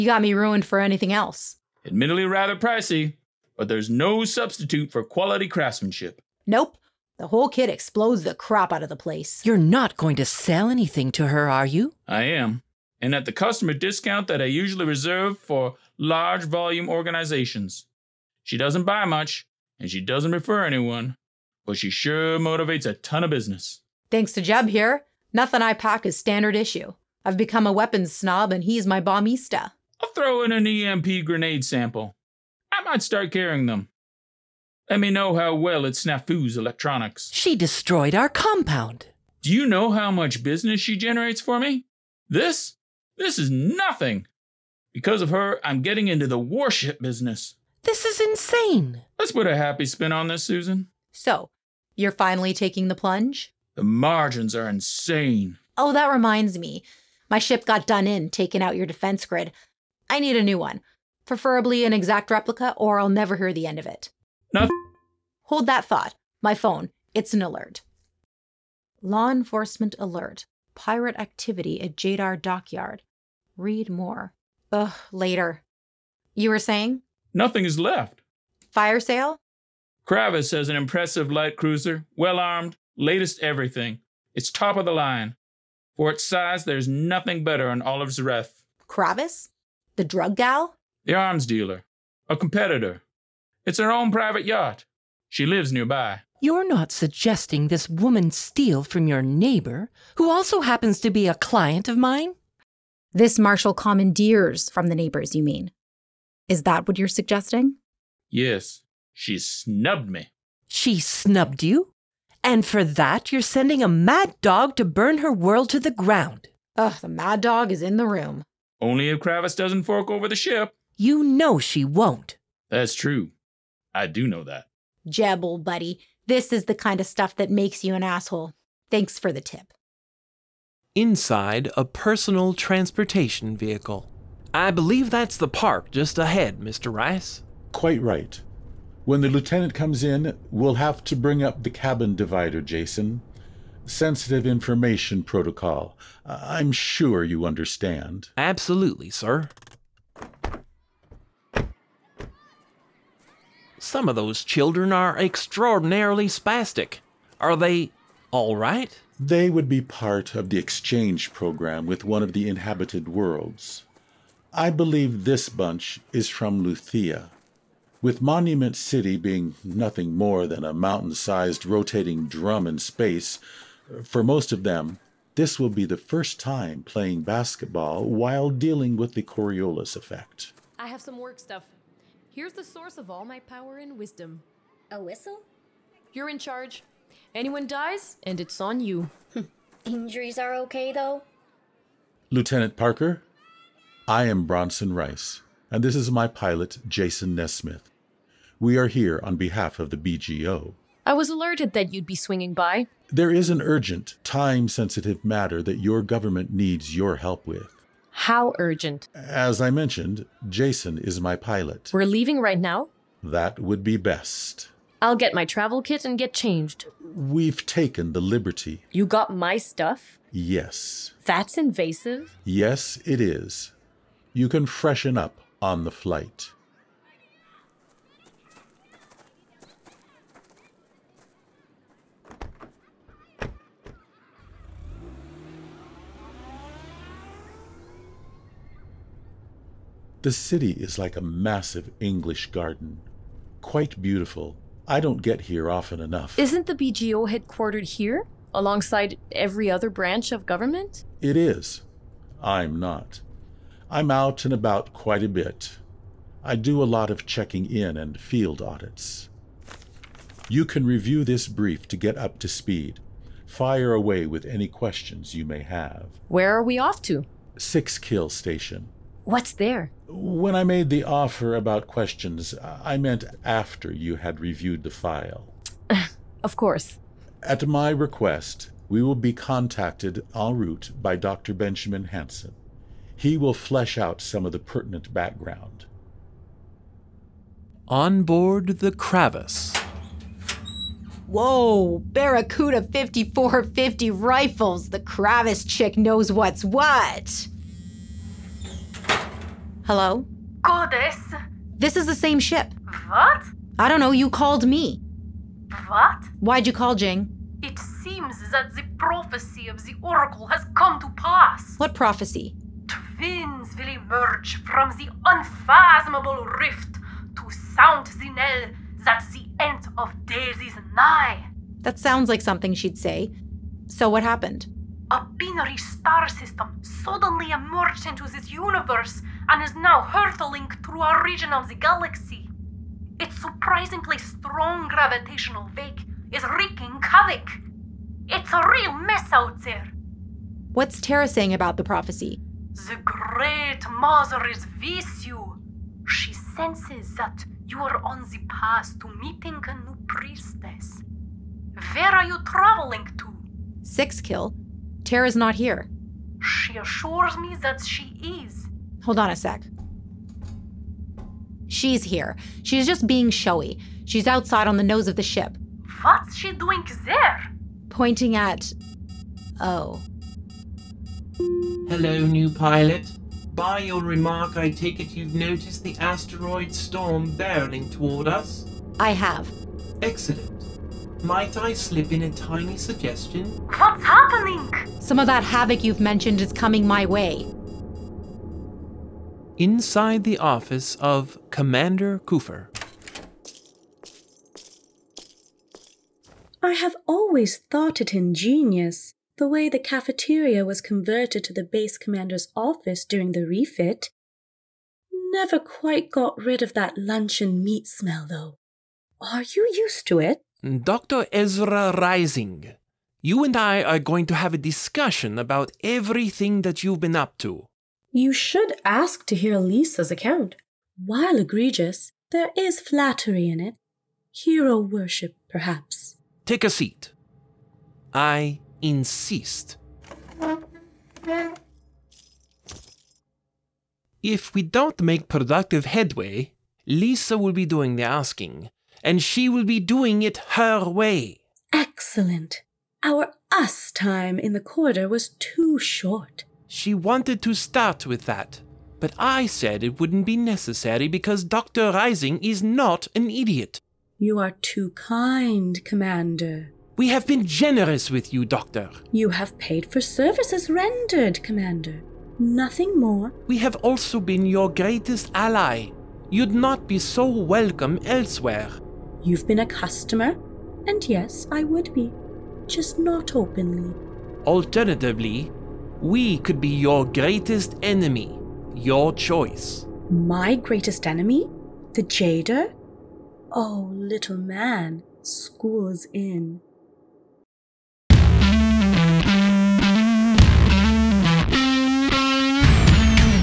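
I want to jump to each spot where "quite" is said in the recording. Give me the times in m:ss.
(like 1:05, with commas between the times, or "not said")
2:17, 4:03, 4:14, 6:45.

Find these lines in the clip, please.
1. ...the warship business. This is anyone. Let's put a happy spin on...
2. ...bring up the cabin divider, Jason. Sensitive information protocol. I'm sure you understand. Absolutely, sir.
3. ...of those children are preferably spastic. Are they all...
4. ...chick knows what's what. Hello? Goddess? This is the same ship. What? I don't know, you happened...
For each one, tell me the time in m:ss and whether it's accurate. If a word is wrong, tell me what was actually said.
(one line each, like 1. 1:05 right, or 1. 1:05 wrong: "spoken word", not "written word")
1. 0:46 wrong: "insane", not "anyone"
2. 2:21 right
3. 2:34 wrong: "extraordinarily", not "preferably"
4. 4:55 wrong: "called", not "happened".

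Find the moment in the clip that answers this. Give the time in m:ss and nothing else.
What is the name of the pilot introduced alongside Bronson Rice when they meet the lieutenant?
3:16.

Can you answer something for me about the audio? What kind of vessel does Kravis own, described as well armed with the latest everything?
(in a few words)
Light cruiser.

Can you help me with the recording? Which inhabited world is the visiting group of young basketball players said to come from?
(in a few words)
Luthea.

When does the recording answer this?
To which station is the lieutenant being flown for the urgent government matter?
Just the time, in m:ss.
4:27.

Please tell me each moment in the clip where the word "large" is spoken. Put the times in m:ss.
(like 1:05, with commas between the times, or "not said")
0:15.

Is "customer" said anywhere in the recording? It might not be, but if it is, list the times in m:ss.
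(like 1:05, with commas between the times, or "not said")
0:13, 7:49.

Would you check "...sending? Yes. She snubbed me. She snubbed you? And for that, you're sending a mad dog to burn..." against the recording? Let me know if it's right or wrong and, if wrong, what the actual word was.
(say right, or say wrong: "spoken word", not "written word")
wrong: "suggesting", not "sending".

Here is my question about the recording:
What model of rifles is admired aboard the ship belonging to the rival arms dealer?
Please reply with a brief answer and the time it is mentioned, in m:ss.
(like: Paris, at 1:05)
Barracuda 5450, at 4:52.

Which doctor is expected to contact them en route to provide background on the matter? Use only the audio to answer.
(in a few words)
Benjamin Hanson.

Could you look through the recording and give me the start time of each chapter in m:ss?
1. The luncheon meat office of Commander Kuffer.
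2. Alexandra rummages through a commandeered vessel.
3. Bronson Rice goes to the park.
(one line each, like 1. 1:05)
1. 6:29
2. 4:46
3. 2:10.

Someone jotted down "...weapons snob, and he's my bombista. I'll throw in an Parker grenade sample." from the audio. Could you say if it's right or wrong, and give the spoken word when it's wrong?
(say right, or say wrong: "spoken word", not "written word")
wrong: "EMP", not "Parker".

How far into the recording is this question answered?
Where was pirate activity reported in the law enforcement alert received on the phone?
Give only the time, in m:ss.
1:11.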